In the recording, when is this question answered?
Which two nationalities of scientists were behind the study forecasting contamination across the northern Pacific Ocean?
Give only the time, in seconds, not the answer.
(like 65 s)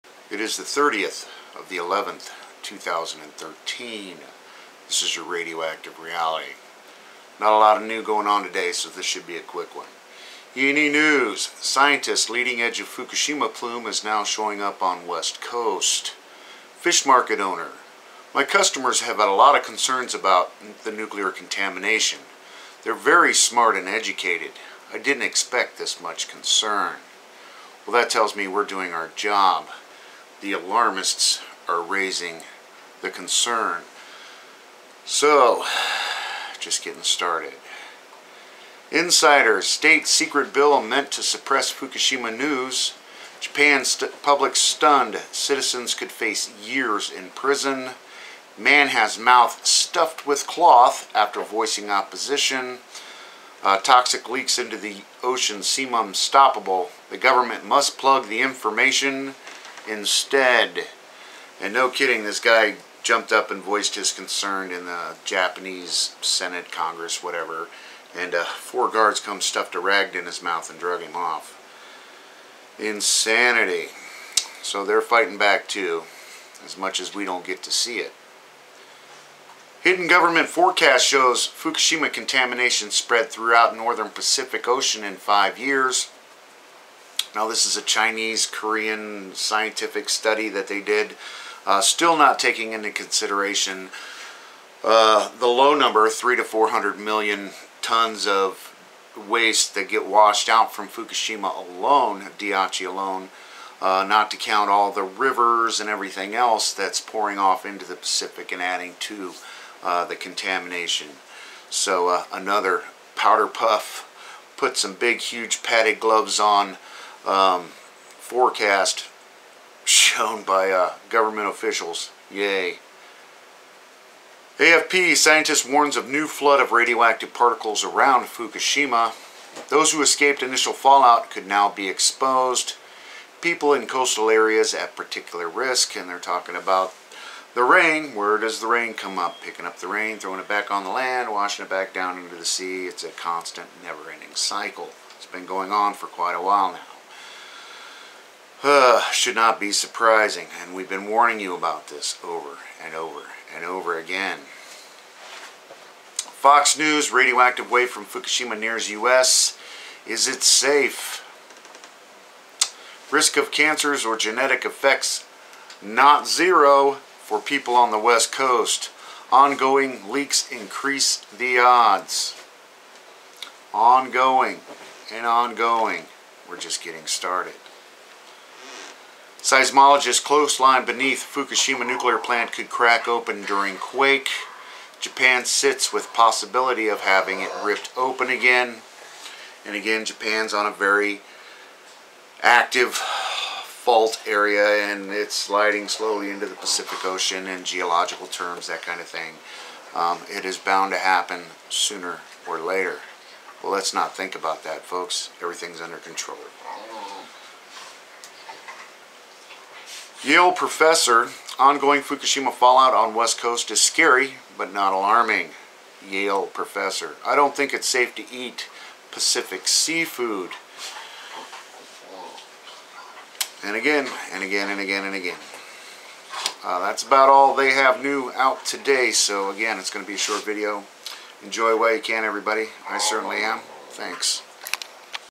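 87 s.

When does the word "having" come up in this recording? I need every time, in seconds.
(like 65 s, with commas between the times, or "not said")
187 s.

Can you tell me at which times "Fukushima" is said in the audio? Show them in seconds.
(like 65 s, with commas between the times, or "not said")
12 s, 41 s, 81 s, 100 s, 128 s, 158 s, 181 s, 212 s.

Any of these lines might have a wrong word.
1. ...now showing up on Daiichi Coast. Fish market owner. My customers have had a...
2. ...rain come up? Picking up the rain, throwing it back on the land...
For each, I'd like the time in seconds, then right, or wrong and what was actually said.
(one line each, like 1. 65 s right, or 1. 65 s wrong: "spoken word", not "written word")
1. 14 s wrong: "West", not "Daiichi"
2. 138 s right.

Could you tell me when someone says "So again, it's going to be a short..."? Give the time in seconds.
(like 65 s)
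229 s.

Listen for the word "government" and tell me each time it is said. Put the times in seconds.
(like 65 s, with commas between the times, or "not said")
57 s, 80 s, 121 s.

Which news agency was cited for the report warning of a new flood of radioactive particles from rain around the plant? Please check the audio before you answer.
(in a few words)
AFP.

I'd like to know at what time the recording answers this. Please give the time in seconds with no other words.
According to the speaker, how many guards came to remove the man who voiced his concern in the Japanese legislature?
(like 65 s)
68 s.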